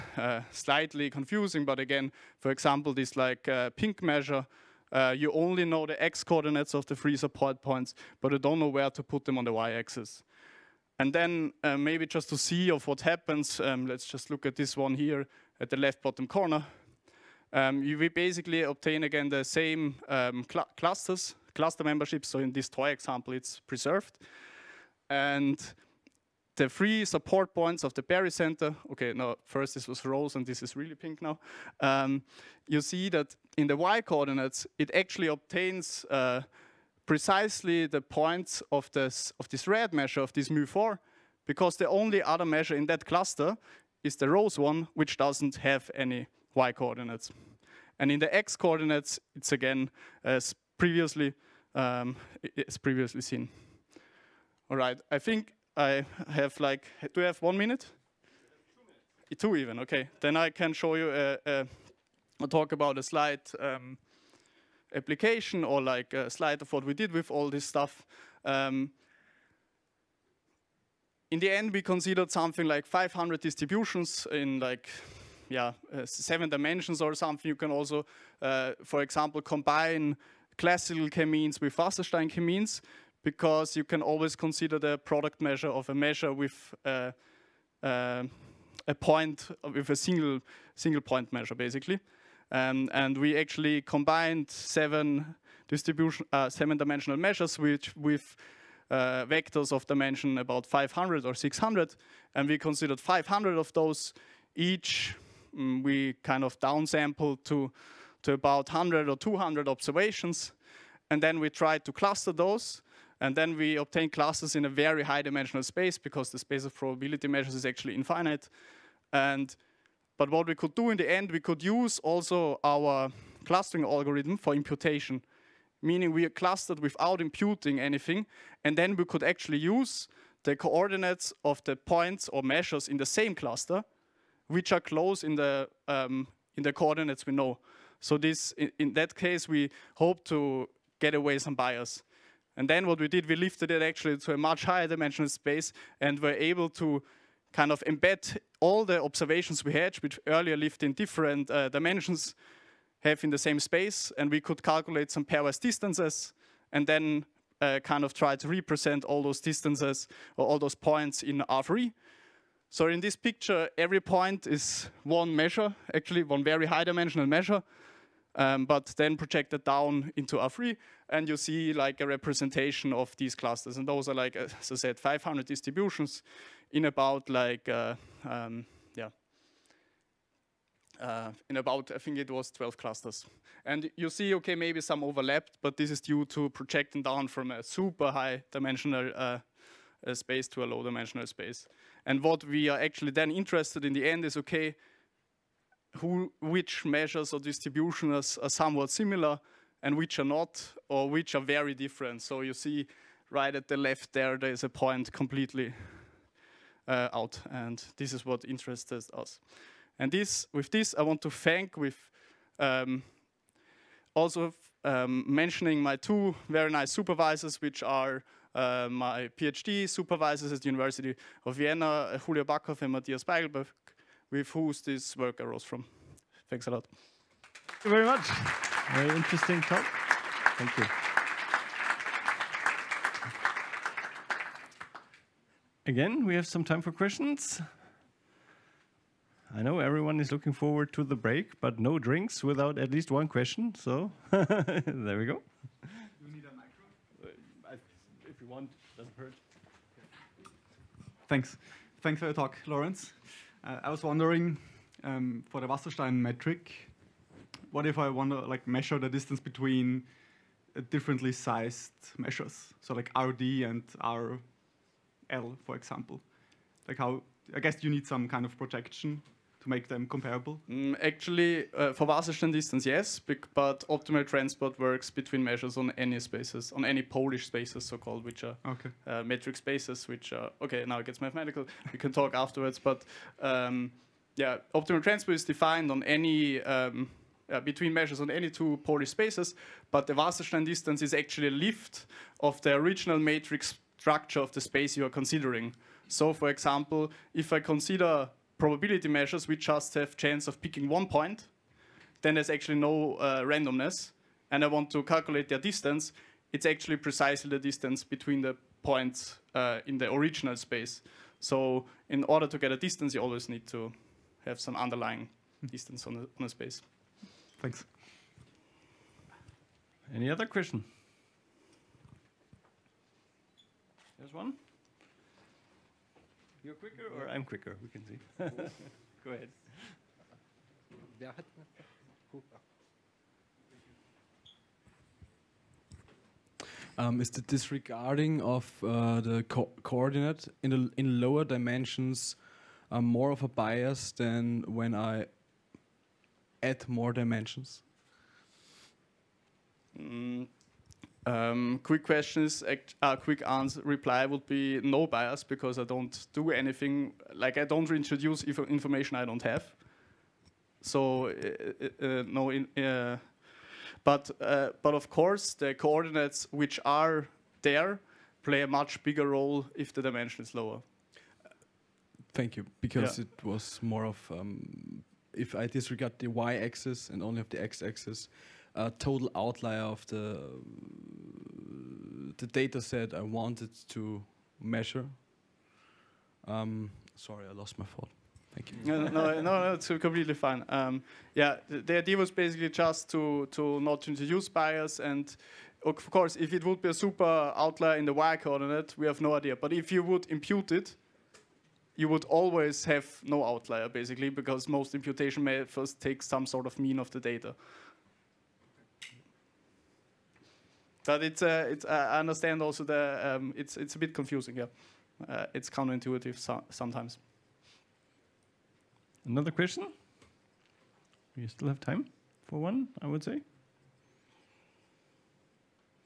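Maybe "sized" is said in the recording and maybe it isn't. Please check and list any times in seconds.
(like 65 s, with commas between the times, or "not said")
261 s.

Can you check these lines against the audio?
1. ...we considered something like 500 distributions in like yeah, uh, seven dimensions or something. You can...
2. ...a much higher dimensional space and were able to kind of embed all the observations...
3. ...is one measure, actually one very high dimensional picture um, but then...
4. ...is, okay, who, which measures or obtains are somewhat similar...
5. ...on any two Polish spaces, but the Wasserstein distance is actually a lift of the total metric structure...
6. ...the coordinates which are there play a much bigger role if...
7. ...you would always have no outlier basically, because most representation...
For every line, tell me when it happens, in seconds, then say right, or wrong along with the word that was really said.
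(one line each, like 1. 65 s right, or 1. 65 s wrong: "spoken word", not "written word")
1. 71 s right
2. 144 s right
3. 164 s wrong: "measure", not "picture"
4. 194 s wrong: "distributions", not "obtains"
5. 288 s wrong: "original", not "total"
6. 365 s right
7. 401 s wrong: "imputation", not "representation".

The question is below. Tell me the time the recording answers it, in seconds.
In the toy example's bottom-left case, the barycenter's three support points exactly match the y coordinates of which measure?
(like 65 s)
40 s.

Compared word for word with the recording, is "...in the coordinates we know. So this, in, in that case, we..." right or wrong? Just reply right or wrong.
right.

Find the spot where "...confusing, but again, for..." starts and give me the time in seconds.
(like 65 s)
1 s.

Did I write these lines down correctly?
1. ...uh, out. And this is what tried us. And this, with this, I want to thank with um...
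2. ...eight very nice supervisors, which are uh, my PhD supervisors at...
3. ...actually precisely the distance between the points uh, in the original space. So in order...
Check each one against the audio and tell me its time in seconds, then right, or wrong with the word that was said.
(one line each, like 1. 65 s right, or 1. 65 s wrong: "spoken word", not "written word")
1. 206 s wrong: "interested", not "tried"
2. 215 s wrong: "two", not "eight"
3. 306 s right.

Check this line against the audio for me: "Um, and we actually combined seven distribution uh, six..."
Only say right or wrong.
wrong.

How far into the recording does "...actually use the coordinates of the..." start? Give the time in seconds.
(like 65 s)
129 s.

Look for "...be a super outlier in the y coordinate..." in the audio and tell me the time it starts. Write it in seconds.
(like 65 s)
396 s.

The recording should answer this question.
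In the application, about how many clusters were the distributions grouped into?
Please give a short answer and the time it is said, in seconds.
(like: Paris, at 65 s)
12, at 182 s.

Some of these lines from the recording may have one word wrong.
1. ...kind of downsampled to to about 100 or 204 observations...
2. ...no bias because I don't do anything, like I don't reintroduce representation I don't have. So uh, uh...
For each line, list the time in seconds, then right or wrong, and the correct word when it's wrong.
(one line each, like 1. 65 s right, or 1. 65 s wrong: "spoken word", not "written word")
1. 106 s wrong: "200", not "204"
2. 354 s wrong: "information", not "representation".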